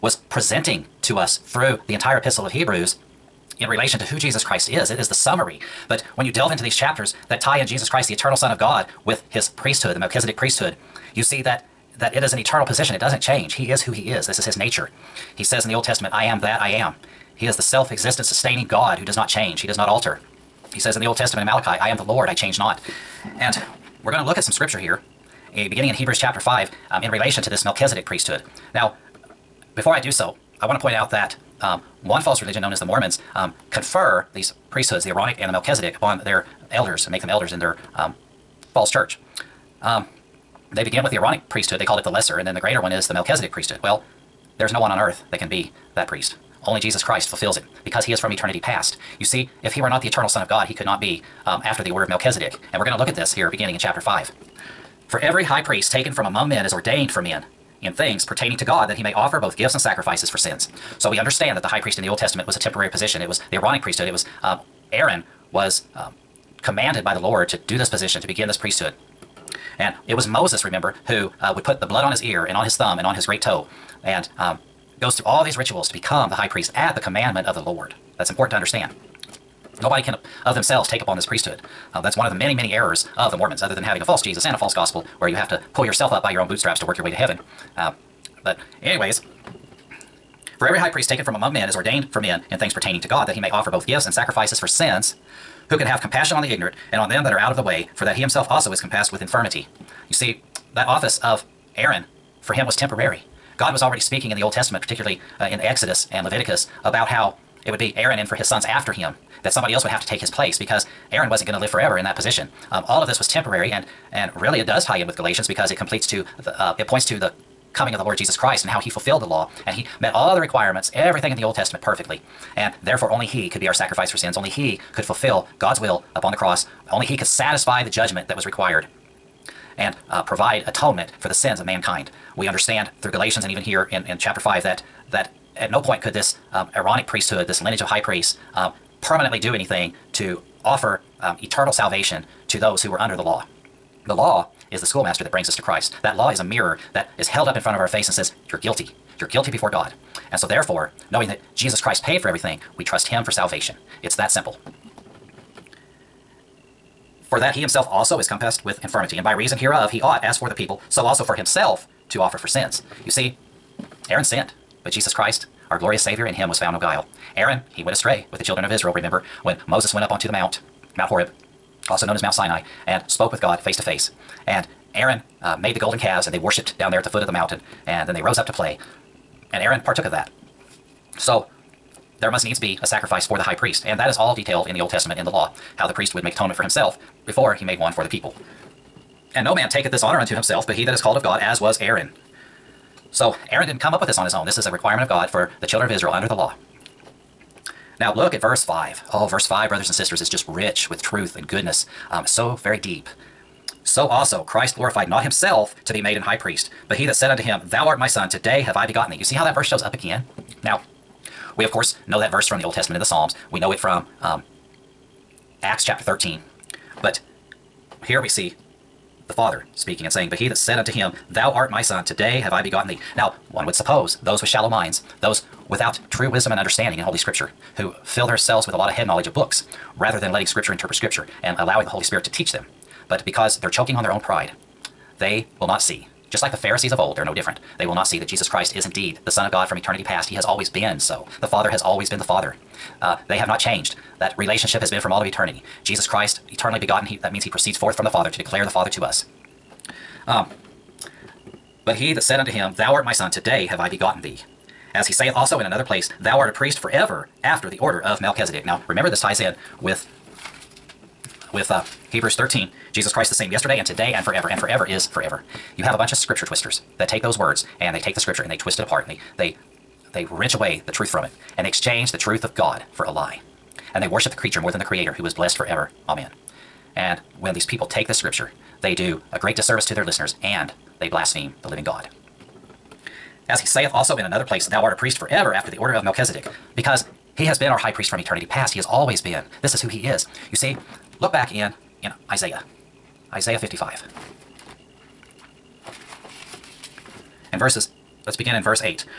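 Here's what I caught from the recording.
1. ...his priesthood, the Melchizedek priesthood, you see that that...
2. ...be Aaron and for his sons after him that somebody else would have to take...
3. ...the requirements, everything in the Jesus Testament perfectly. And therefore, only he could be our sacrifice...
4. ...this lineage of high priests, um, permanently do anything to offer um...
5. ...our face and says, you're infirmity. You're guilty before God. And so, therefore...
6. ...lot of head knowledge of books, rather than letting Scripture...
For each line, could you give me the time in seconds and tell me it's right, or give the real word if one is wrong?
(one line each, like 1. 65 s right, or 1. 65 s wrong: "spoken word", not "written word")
1. 9 s right
2. 107 s right
3. 120 s wrong: "Old", not "Jesus"
4. 137 s right
5. 147 s wrong: "guilty", not "infirmity"
6. 228 s right.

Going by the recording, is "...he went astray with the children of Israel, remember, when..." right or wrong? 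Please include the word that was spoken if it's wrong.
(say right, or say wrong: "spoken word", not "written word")
right.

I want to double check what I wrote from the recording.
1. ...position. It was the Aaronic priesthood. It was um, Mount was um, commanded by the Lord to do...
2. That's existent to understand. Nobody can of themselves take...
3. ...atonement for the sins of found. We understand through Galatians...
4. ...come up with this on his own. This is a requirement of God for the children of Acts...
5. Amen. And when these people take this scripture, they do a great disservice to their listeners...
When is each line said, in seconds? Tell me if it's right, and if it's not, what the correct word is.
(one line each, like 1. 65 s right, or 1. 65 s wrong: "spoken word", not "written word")
1. 62 s wrong: "Aaron", not "Mount"
2. 78 s wrong: "important", not "existent"
3. 130 s wrong: "mankind", not "found"
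4. 193 s wrong: "Israel", not "Acts"
5. 276 s right.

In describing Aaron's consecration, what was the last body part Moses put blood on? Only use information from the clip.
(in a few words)
great toe.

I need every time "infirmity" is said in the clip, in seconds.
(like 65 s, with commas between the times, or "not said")
99 s, 158 s.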